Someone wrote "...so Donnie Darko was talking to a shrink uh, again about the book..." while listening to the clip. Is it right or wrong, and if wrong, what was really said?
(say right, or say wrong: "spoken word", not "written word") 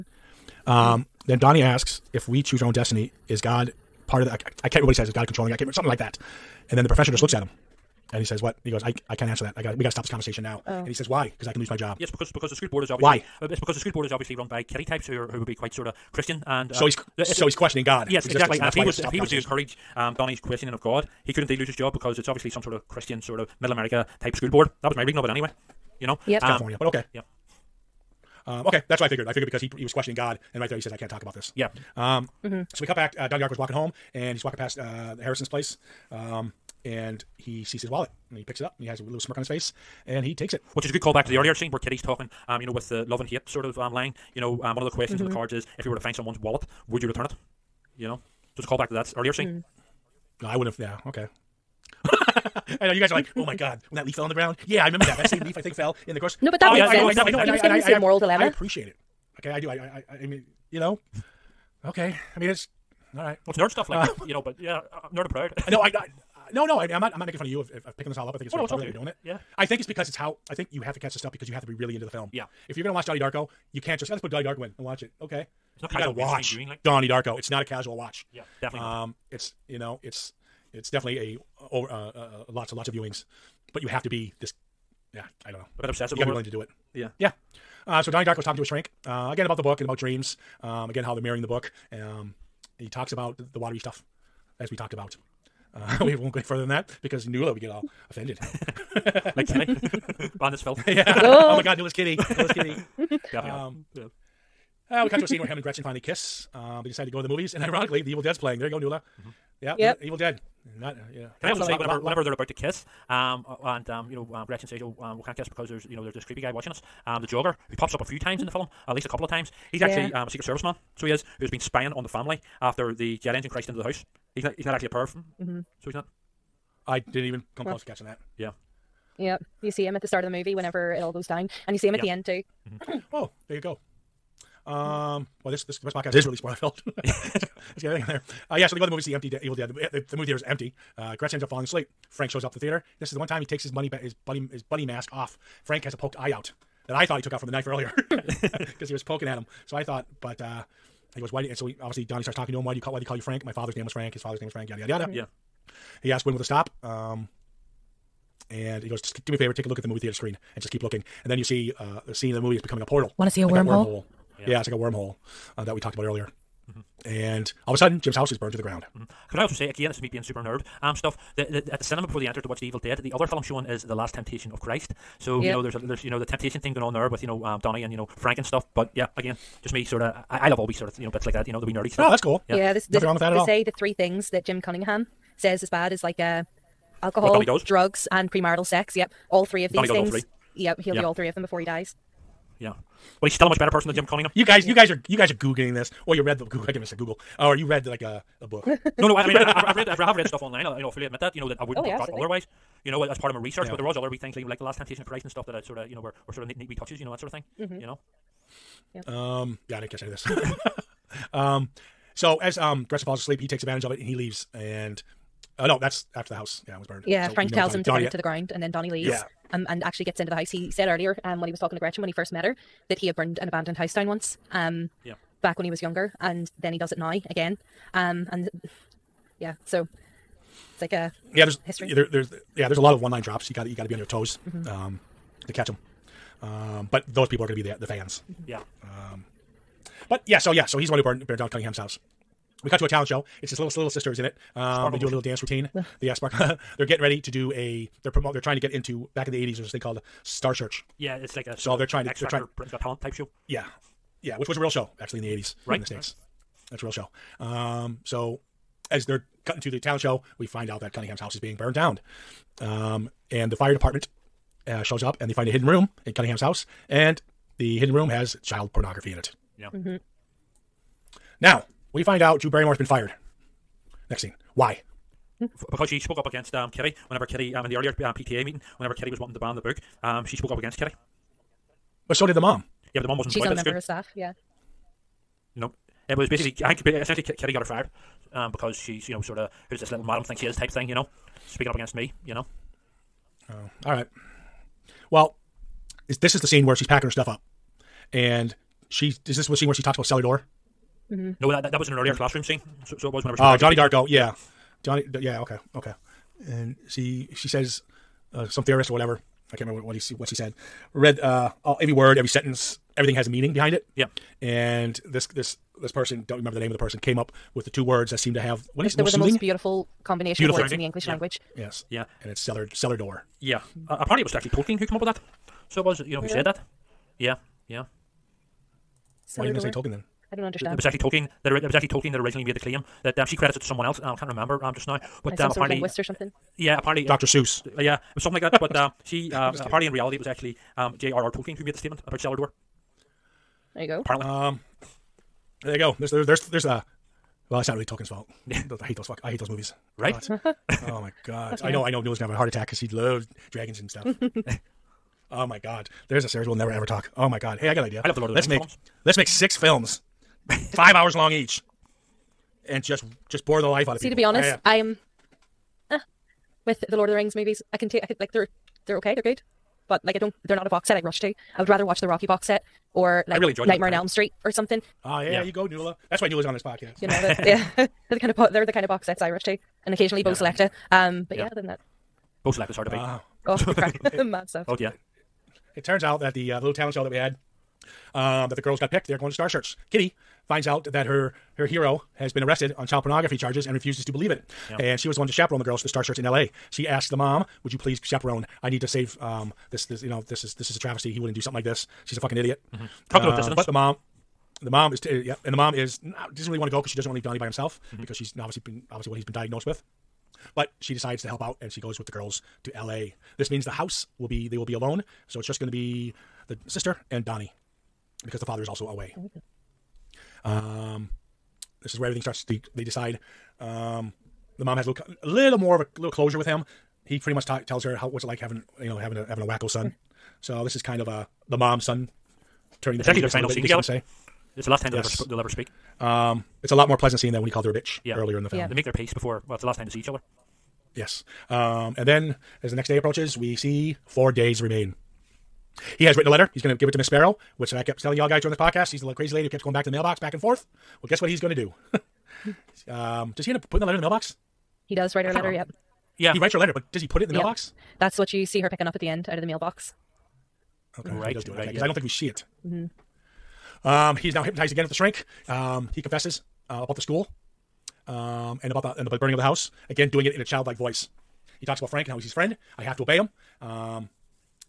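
right.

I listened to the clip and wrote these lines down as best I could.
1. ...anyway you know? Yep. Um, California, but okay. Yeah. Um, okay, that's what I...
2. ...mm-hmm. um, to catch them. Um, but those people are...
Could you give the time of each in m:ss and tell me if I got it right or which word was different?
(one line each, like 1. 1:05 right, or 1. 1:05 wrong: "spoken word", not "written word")
1. 0:25 right
2. 3:54 right.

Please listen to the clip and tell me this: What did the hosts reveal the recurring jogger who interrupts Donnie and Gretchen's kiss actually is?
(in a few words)
Secret Service man.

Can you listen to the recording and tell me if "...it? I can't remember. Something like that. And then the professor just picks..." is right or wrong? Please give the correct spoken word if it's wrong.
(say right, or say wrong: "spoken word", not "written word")
wrong: "looks", not "picks".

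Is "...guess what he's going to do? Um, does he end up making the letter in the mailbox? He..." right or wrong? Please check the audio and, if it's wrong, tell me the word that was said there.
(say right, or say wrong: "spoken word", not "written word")
wrong: "putting", not "making".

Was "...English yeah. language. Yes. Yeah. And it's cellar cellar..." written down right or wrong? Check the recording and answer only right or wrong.
right.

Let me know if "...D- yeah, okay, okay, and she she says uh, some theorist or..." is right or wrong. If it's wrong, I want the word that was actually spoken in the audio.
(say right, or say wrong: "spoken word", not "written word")
right.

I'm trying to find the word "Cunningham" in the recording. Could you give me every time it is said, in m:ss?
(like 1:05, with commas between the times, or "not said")
3:04, 3:14, 4:01, 4:20, 4:26.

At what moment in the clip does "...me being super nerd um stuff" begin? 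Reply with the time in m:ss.
2:50.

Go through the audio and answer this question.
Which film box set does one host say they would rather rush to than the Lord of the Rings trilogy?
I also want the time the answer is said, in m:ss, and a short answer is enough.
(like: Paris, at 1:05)
Rocky, at 6:12.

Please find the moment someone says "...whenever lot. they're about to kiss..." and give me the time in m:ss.
1:52.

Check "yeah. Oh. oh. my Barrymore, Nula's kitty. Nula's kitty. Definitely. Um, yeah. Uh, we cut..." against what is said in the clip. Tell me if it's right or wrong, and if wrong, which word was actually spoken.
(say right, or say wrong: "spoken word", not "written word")
wrong: "God", not "Barrymore".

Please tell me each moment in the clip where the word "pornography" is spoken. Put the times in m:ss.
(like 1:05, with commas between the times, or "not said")
4:28, 6:33.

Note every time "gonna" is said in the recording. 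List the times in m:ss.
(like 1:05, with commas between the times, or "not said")
1:12, 5:52.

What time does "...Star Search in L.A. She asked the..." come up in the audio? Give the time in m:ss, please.
6:35.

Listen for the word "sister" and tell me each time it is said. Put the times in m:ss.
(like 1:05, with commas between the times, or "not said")
4:03, 6:56.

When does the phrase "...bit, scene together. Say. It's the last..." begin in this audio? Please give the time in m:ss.
7:13.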